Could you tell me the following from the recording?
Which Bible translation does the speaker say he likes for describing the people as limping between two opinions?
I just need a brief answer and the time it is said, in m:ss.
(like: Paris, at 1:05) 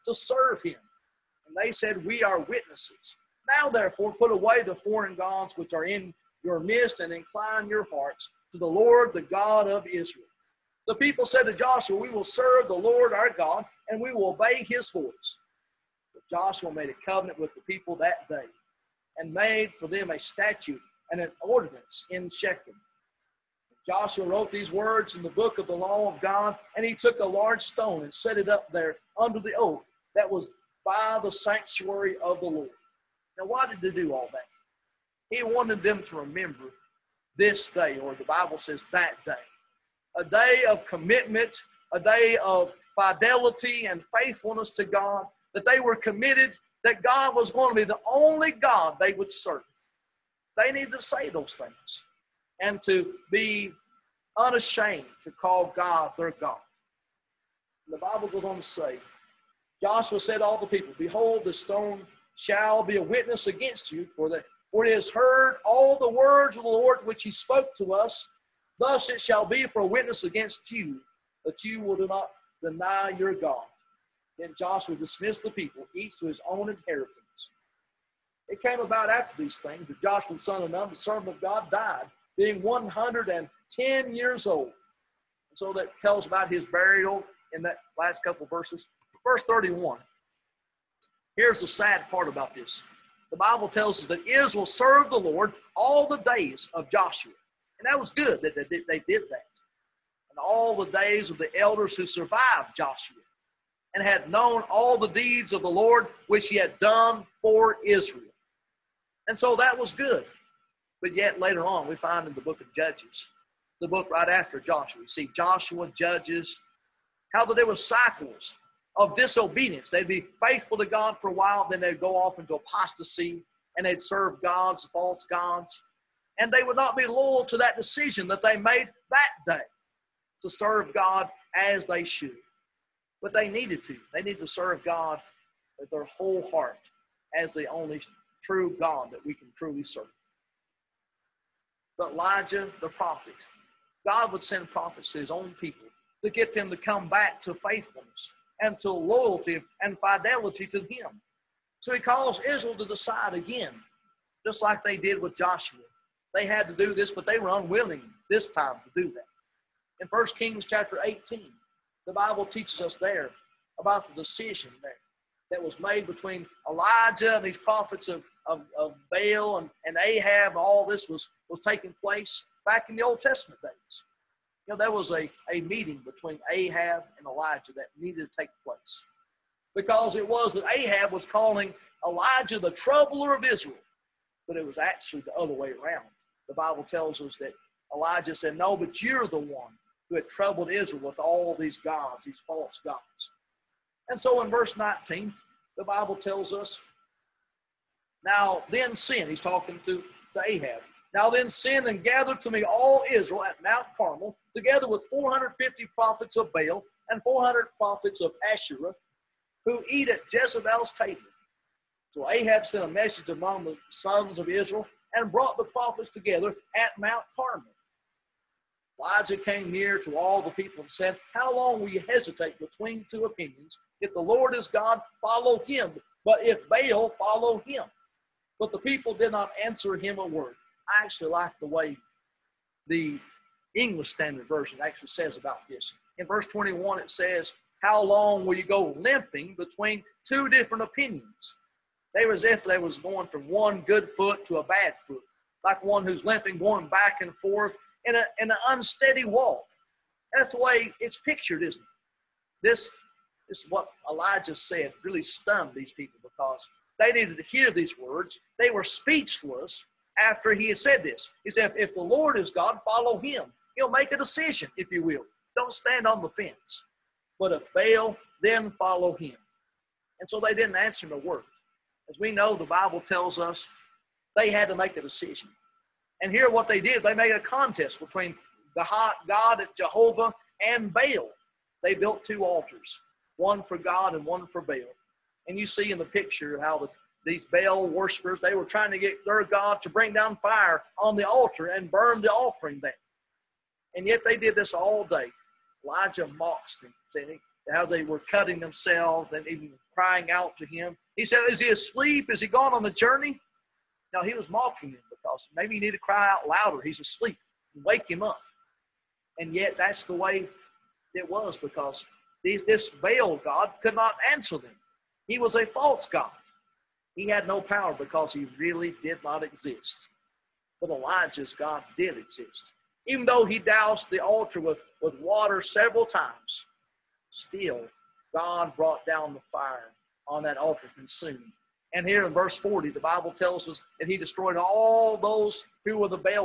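English Standard Version, at 3:53.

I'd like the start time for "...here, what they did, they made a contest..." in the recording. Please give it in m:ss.
4:36.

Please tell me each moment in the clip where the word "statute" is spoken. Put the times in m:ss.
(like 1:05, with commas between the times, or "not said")
0:20.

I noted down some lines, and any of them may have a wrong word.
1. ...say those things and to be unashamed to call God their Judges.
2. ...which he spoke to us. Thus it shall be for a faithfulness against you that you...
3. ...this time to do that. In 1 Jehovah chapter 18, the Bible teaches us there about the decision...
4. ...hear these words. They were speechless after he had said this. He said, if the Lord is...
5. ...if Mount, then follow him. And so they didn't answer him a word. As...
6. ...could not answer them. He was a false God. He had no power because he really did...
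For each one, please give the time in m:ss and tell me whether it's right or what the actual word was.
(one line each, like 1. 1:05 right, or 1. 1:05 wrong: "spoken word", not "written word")
1. 0:50 wrong: "God", not "Judges"
2. 1:07 wrong: "witness", not "faithfulness"
3. 2:38 wrong: "Kings", not "Jehovah"
4. 4:17 right
5. 4:27 wrong: "Baal", not "Mount"
6. 5:13 right.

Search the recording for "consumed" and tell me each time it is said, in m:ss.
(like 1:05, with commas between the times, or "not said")
5:30.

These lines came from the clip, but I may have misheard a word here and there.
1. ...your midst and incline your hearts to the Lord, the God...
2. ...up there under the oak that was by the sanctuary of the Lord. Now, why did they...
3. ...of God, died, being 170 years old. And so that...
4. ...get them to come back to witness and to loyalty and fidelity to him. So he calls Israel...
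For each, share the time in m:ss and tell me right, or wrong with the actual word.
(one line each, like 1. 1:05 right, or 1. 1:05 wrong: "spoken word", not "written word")
1. 0:06 right
2. 0:28 right
3. 1:21 wrong: "110", not "170"
4. 2:26 wrong: "faithfulness", not "witness".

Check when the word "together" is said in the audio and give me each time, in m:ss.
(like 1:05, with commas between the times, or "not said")
3:24, 3:36.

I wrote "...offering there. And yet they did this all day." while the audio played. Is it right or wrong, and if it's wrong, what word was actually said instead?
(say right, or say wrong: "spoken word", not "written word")
right.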